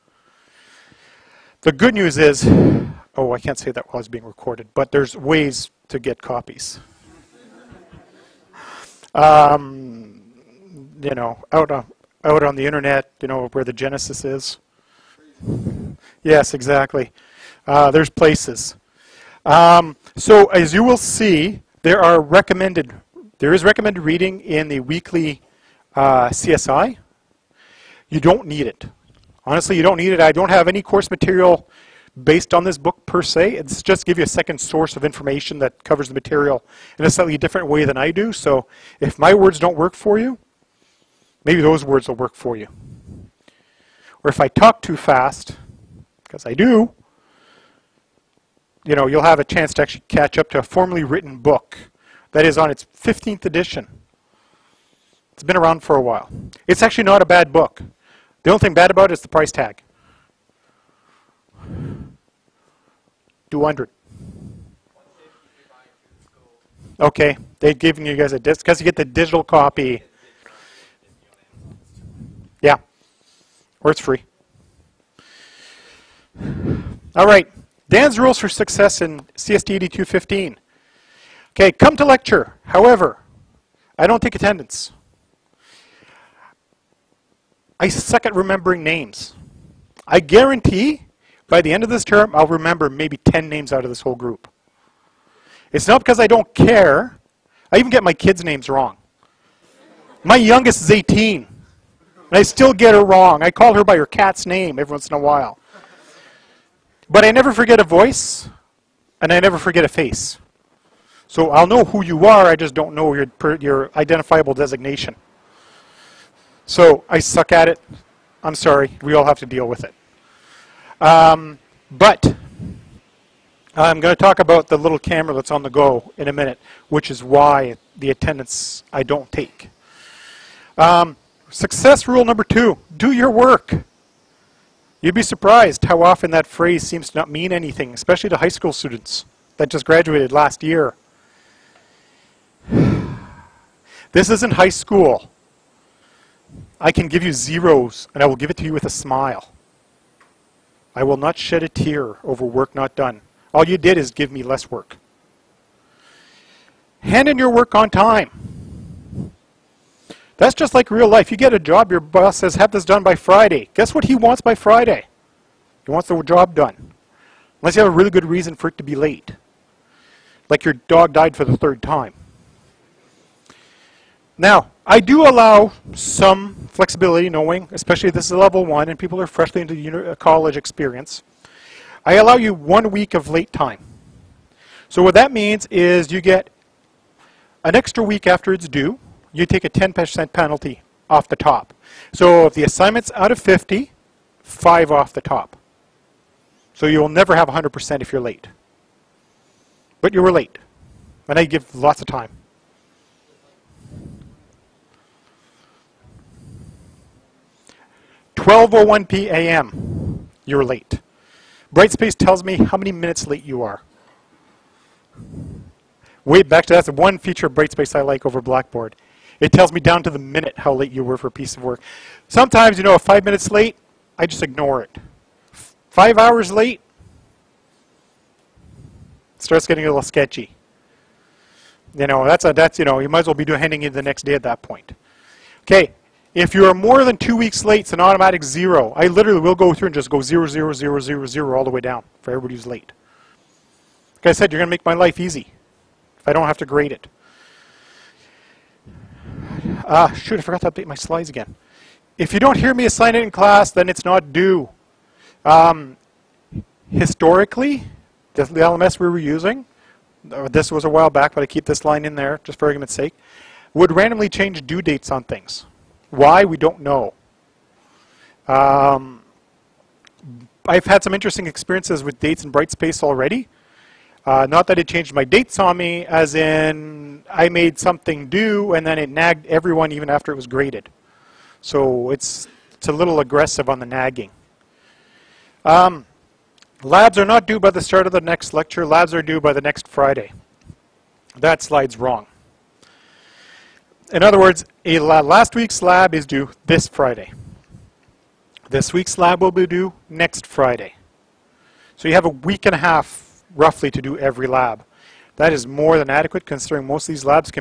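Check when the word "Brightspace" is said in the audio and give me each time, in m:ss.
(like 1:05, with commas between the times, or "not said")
3:31, 3:37, 4:32.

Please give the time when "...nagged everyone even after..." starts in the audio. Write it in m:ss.
4:39.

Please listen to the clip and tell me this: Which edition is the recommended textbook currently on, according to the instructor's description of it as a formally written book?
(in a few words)
15th edition.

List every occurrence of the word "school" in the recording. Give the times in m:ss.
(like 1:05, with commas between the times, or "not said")
2:18, 2:24.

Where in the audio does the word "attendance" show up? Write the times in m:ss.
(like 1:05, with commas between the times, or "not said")
1:24, 2:08.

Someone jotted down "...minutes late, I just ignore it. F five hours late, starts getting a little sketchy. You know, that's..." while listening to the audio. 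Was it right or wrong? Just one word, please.
right.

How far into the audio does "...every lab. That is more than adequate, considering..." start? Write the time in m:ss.
5:04.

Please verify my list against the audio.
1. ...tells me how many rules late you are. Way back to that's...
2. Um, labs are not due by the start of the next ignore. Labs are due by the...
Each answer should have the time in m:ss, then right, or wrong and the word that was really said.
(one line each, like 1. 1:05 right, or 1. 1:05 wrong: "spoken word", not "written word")
1. 3:32 wrong: "minutes", not "rules"
2. 4:45 wrong: "lecture", not "ignore".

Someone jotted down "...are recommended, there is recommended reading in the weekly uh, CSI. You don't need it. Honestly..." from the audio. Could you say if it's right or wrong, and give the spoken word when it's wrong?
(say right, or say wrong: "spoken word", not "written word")
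right.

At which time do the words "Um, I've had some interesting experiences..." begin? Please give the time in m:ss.
4:28.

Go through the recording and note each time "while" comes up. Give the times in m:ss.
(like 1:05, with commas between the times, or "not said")
0:03, 0:56, 1:45, 4:20.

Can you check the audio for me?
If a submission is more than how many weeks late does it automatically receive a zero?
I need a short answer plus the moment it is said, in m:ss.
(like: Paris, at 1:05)
2 weeks, at 3:57.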